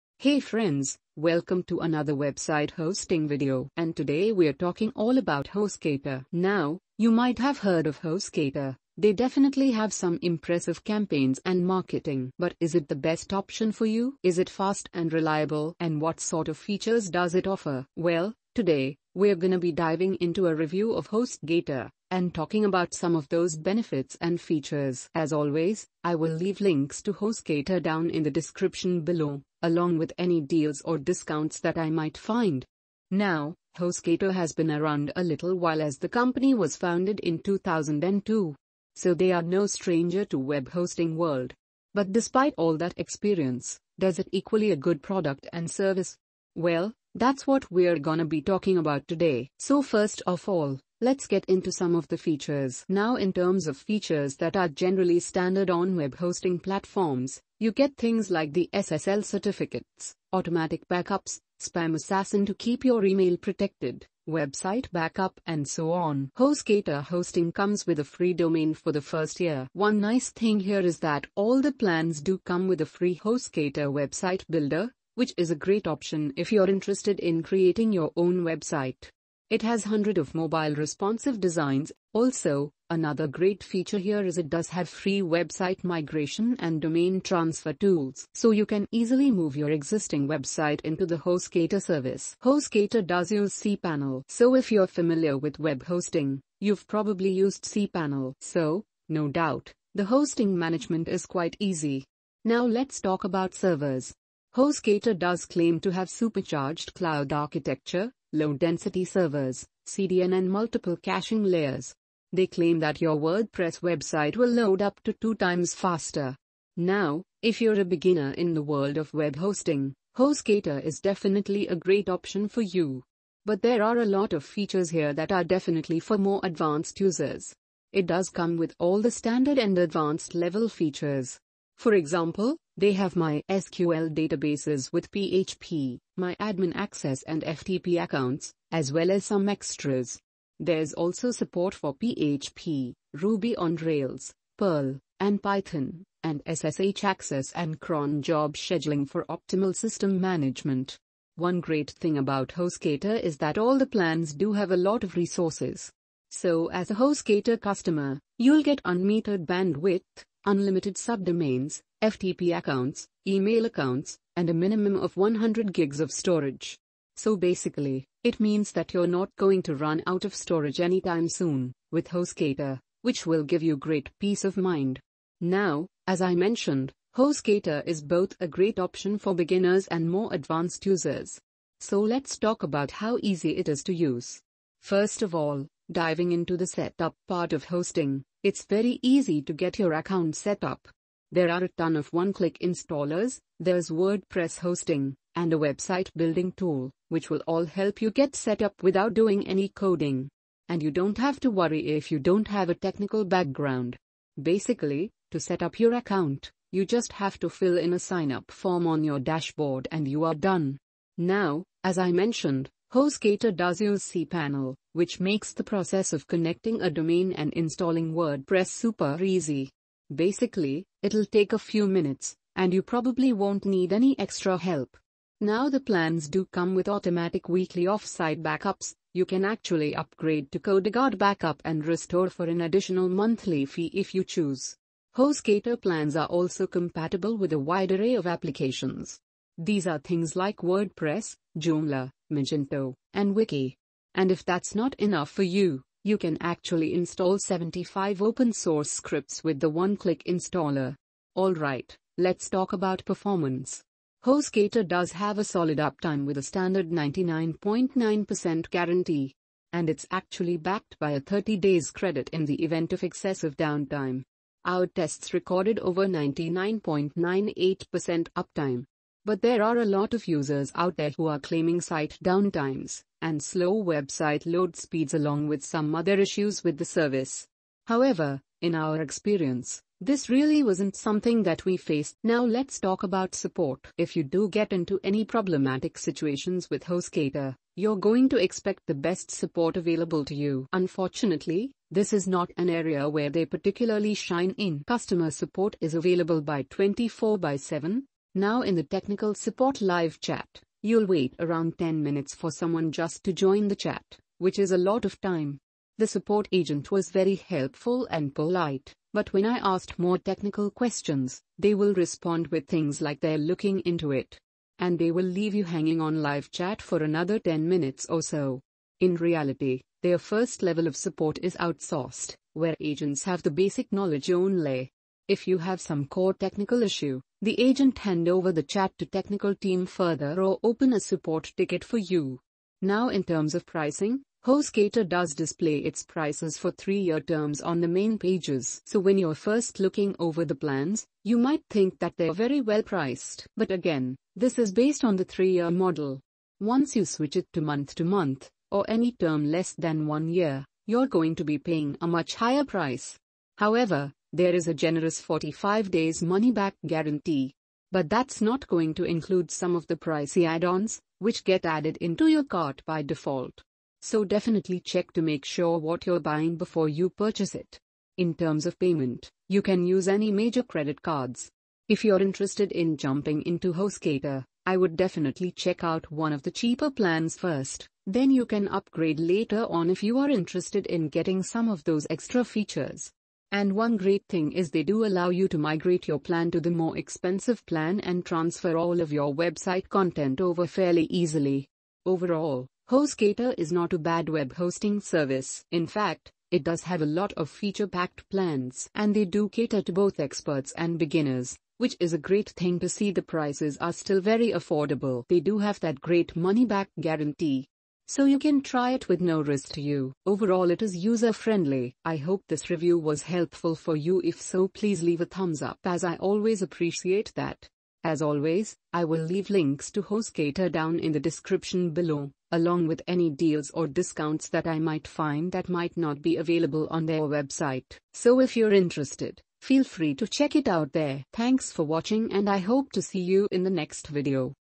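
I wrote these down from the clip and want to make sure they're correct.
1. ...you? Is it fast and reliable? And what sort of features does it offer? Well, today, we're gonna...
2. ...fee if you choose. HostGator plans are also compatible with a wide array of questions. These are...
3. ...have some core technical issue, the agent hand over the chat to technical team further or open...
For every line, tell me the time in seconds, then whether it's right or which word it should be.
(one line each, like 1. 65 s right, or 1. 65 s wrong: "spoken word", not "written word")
1. 13 s right
2. 233 s wrong: "applications", not "questions"
3. 325 s right.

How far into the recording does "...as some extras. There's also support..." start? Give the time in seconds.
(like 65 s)
139 s.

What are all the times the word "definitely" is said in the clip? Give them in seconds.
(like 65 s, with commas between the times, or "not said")
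9 s, 121 s, 125 s, 364 s, 374 s.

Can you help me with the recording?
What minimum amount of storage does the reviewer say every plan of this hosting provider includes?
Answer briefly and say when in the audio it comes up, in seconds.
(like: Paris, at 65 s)
100 gigs, at 165 s.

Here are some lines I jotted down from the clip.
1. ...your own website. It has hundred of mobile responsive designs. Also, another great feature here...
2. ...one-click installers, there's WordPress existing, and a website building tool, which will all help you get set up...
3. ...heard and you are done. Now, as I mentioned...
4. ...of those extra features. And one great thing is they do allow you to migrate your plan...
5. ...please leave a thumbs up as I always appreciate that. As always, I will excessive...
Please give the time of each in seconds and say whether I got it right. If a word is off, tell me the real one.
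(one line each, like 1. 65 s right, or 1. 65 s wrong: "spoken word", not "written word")
1. 77 s right
2. 192 s wrong: "hosting", not "existing"
3. 209 s wrong: "dashboard", not "heard"
4. 381 s right
5. 414 s wrong: "leave", not "excessive".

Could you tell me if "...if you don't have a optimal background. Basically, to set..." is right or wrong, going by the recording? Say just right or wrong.
wrong.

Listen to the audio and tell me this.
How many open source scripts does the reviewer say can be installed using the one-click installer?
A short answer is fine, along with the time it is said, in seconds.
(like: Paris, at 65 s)
75, at 247 s.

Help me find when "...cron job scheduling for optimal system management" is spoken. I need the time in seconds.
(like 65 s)
147 s.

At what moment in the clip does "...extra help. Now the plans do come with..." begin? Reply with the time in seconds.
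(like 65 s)
224 s.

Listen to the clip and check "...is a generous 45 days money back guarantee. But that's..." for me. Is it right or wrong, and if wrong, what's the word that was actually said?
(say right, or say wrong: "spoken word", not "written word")
right.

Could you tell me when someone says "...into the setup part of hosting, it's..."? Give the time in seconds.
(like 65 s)
186 s.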